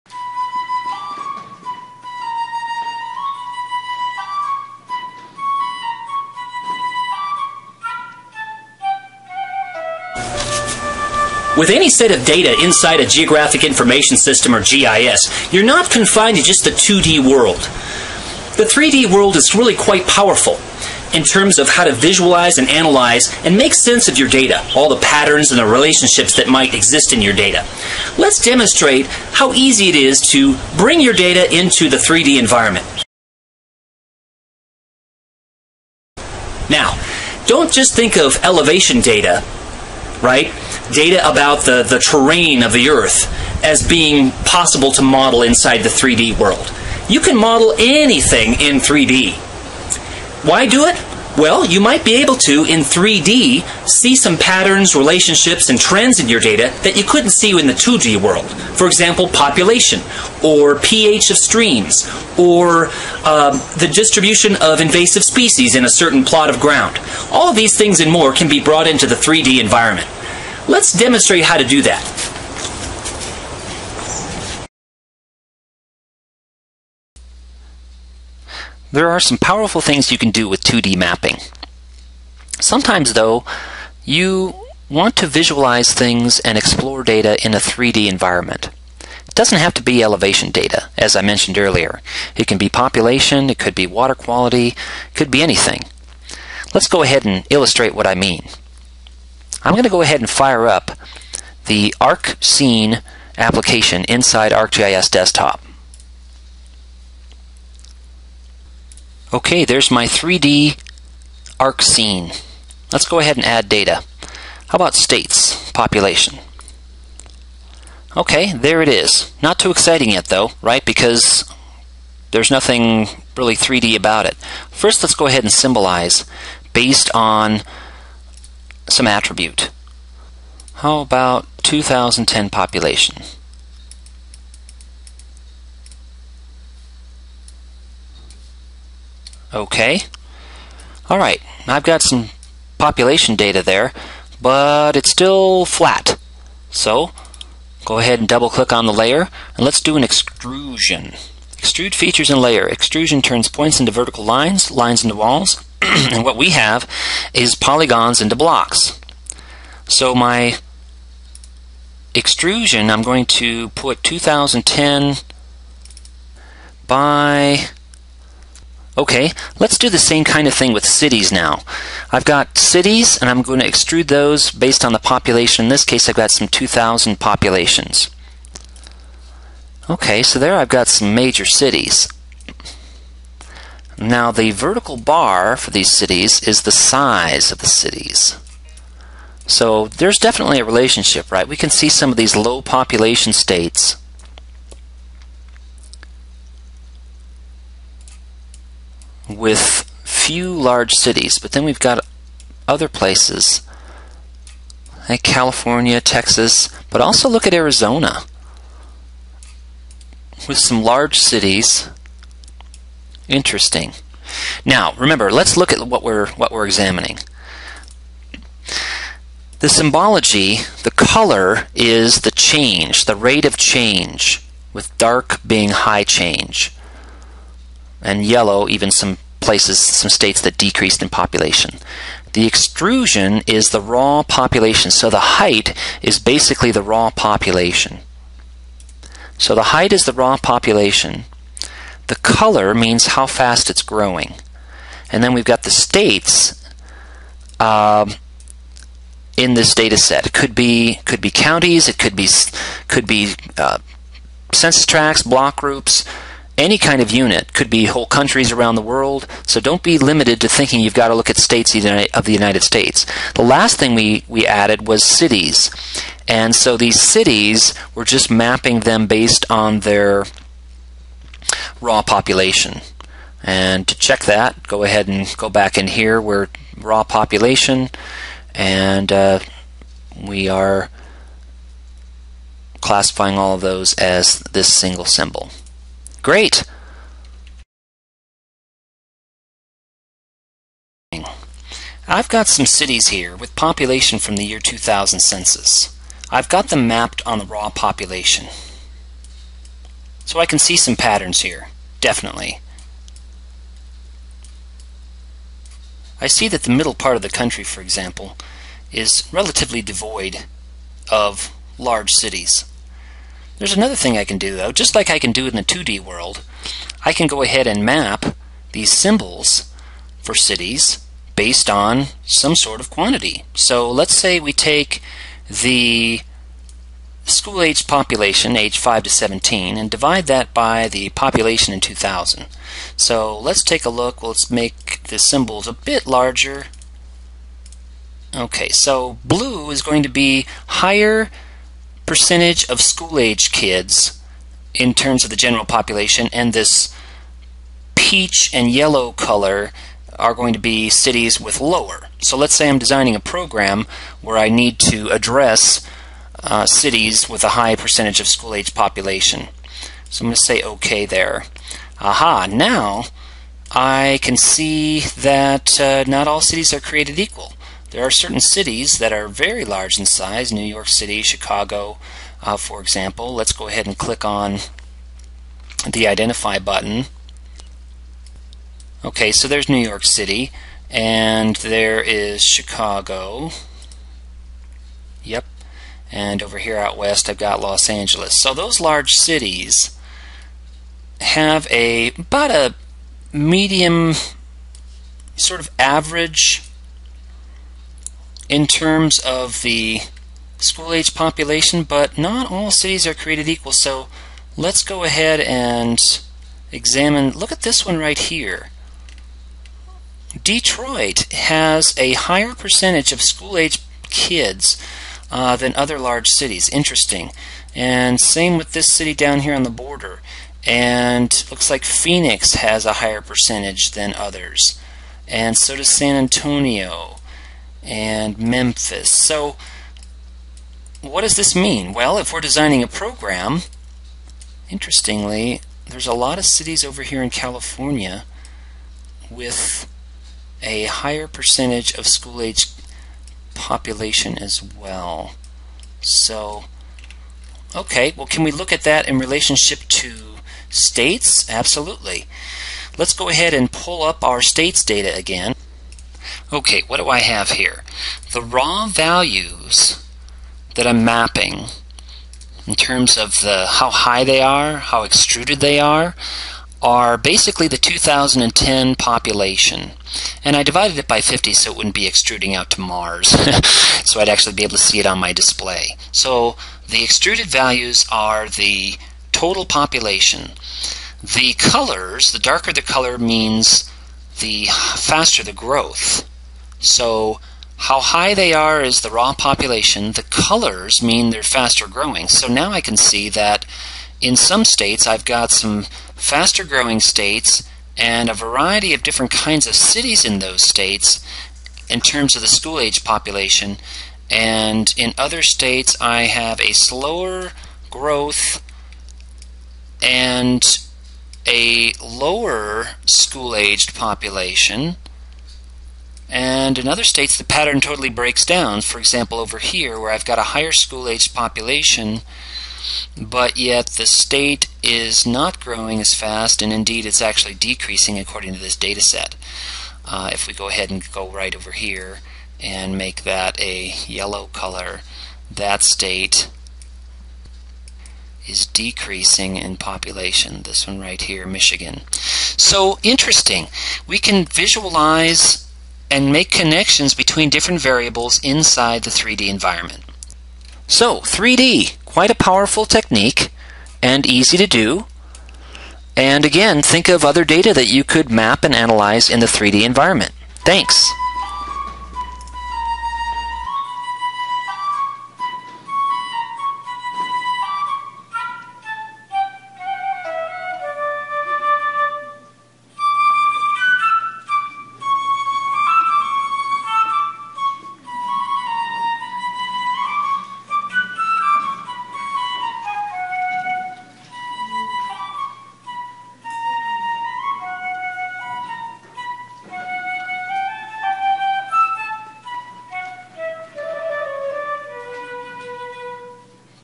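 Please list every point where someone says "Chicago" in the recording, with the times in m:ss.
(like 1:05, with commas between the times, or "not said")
6:11, 6:22.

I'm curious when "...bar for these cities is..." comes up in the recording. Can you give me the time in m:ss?
3:04.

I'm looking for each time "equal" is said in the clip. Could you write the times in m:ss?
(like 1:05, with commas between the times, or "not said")
6:07, 6:43.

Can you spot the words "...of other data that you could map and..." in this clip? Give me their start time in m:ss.
9:17.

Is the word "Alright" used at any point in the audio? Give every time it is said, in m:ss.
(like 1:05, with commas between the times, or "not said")
2:21.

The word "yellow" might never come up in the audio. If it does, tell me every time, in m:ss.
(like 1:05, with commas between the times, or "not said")
3:48, 5:48, 8:54.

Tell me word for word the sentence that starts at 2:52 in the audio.
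I've got cities and I'm going to extrude those based on the population.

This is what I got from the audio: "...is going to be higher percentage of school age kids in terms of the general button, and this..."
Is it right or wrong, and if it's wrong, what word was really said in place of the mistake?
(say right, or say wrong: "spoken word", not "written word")
wrong: "population", not "button".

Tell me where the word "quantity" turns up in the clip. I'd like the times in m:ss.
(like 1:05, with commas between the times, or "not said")
5:22.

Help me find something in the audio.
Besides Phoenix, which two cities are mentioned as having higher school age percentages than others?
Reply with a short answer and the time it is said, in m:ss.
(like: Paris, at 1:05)
San Antonio and Memphis, at 7:05.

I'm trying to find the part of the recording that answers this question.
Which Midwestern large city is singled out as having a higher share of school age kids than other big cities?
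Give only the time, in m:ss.
6:50.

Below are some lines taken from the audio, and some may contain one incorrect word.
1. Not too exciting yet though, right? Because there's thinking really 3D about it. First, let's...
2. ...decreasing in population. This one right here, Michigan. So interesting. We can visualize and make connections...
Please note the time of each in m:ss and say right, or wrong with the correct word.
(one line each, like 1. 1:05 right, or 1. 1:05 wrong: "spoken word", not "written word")
1. 1:59 wrong: "nothing", not "thinking"
2. 8:58 right.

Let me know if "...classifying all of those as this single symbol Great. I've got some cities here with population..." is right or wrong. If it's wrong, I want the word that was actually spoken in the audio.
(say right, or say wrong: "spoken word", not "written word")
right.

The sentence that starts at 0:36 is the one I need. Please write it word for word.
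Now, don't just think of elevation data right?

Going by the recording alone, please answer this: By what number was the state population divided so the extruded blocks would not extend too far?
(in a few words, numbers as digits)
50.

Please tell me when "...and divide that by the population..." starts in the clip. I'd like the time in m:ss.
5:29.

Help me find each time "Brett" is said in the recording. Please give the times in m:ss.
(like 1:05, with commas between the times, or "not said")
not said.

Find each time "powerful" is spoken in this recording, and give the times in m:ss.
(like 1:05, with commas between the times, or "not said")
0:20, 1:19, 9:12.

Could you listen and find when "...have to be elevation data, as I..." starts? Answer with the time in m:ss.
1:29.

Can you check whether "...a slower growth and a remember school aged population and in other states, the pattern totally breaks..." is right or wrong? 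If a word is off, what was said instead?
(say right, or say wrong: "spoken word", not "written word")
wrong: "lower", not "remember".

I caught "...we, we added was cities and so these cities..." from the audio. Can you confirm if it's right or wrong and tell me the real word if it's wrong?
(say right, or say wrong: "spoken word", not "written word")
right.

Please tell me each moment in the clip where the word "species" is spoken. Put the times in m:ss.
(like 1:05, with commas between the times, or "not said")
1:05.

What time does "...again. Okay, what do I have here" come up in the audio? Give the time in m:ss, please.
7:35.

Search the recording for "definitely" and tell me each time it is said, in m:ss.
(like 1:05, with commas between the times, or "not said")
3:10, 5:02.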